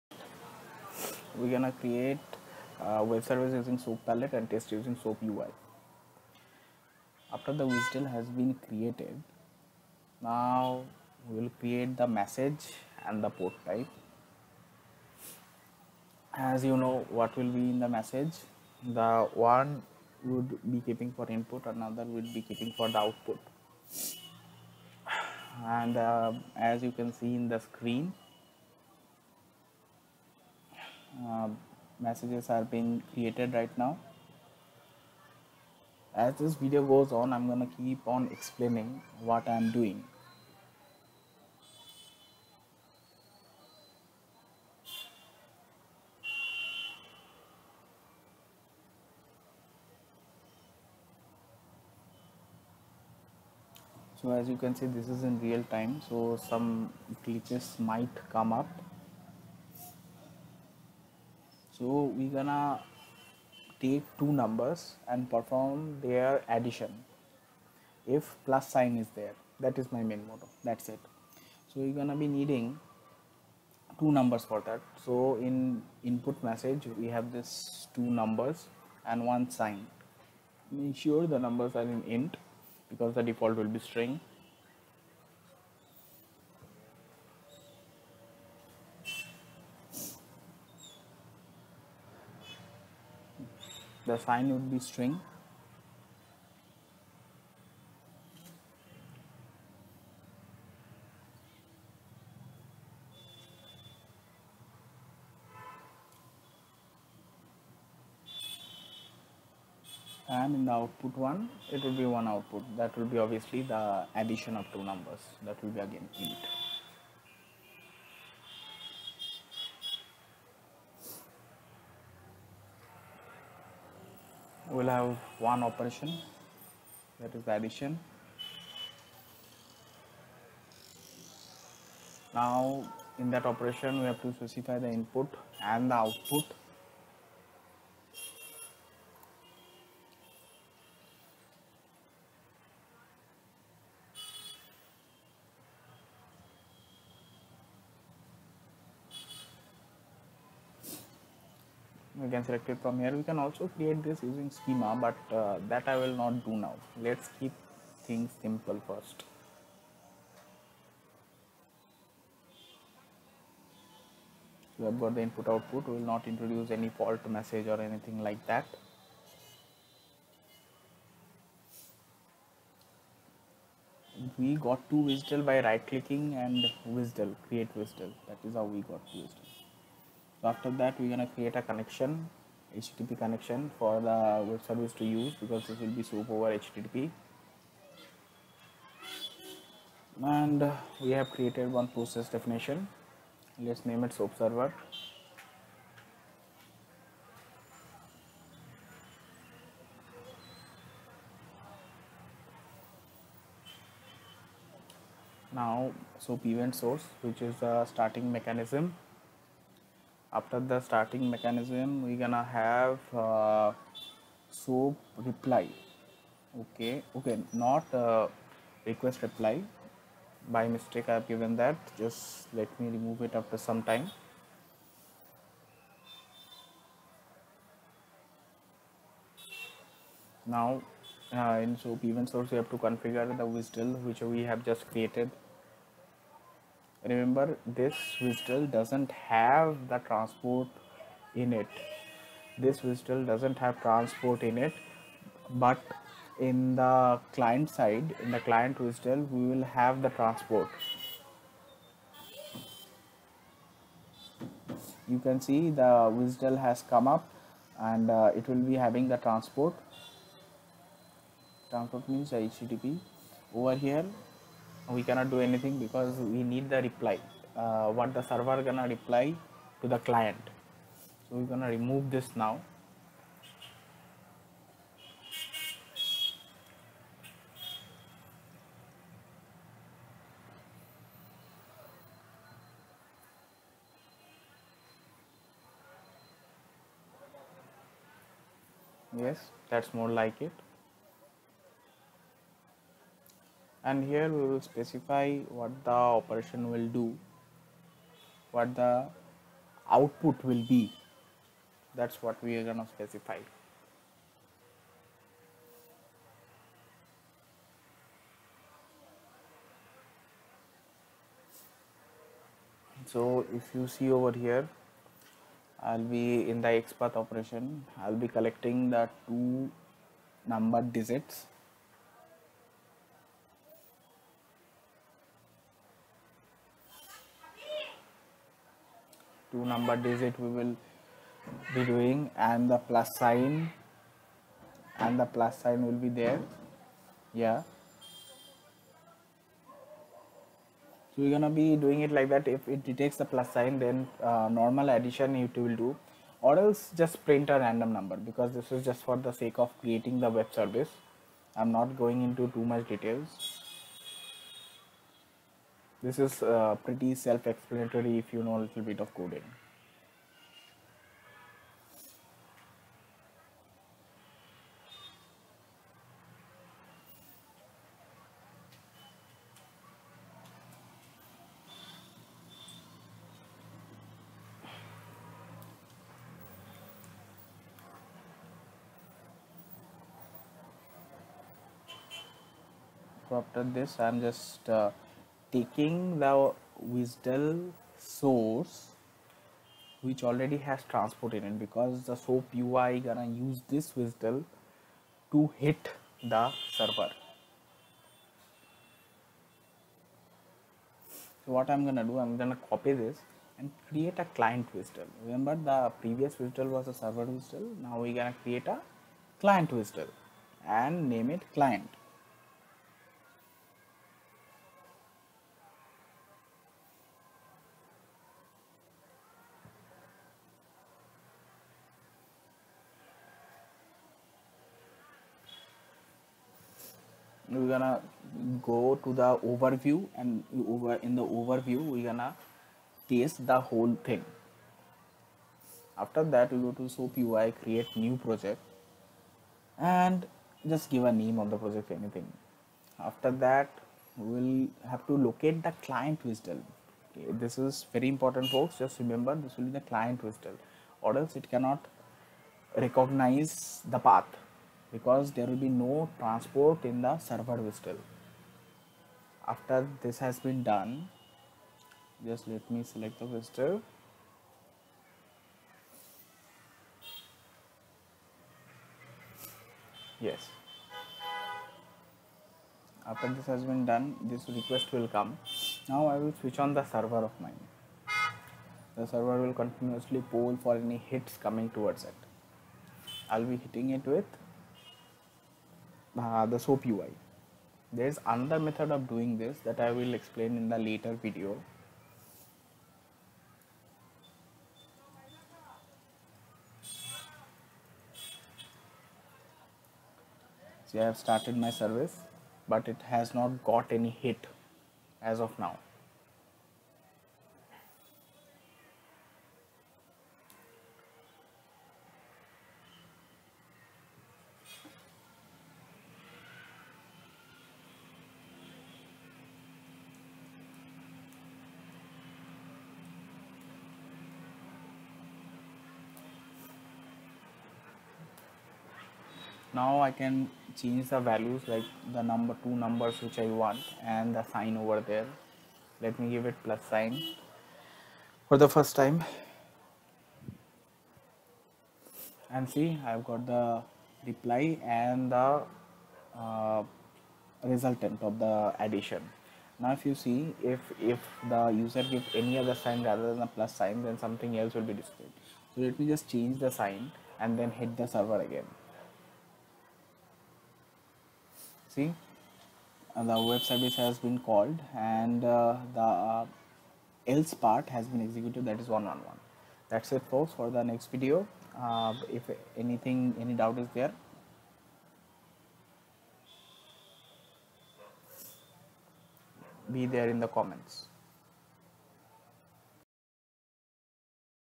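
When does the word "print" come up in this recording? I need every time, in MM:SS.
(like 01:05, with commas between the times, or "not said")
05:47.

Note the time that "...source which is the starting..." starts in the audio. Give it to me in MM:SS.
03:26.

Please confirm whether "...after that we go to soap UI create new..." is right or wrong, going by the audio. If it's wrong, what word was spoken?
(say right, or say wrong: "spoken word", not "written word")
right.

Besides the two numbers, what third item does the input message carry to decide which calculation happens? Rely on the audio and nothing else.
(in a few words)
one sign.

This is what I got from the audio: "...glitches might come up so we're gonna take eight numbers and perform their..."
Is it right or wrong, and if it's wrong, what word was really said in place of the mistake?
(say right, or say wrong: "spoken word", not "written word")
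wrong: "two", not "eight".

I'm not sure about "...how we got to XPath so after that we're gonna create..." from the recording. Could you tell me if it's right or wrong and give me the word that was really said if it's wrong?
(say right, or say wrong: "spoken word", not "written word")
wrong: "WSDL", not "XPath".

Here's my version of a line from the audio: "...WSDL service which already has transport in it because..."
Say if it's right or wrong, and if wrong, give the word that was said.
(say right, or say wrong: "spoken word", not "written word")
wrong: "source", not "service".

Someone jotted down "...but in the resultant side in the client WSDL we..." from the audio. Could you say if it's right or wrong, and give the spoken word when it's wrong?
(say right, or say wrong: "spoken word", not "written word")
wrong: "client", not "resultant".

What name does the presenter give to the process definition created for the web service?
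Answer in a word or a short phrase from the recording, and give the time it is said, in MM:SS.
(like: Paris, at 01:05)
SOAP server, at 03:13.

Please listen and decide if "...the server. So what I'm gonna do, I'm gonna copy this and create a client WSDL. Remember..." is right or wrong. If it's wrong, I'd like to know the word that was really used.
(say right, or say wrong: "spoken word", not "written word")
right.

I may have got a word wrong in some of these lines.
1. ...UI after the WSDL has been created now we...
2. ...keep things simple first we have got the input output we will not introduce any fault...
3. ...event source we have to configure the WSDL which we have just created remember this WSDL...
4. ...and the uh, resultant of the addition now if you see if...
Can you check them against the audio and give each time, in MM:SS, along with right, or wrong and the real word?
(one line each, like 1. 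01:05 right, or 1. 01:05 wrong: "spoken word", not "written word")
1. 00:05 right
2. 02:37 right
3. 03:52 right
4. 09:04 right.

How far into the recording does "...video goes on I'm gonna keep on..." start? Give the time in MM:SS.
00:36.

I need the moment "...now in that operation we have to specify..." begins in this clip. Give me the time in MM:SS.
02:12.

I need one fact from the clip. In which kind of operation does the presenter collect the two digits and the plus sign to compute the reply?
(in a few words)
XPath.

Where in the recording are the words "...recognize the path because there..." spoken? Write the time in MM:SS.
07:32.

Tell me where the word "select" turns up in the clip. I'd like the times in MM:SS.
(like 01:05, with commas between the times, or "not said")
02:32, 07:42.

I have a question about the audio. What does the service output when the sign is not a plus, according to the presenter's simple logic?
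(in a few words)
a random number.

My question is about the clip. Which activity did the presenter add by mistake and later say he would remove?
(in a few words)
request reply.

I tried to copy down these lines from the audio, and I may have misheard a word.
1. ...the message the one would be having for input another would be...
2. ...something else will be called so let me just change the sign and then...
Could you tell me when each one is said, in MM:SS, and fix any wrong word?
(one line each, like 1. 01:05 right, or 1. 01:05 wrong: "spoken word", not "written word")
1. 00:17 wrong: "keeping", not "having"
2. 09:14 wrong: "displayed", not "called".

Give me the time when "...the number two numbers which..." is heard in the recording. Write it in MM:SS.
08:52.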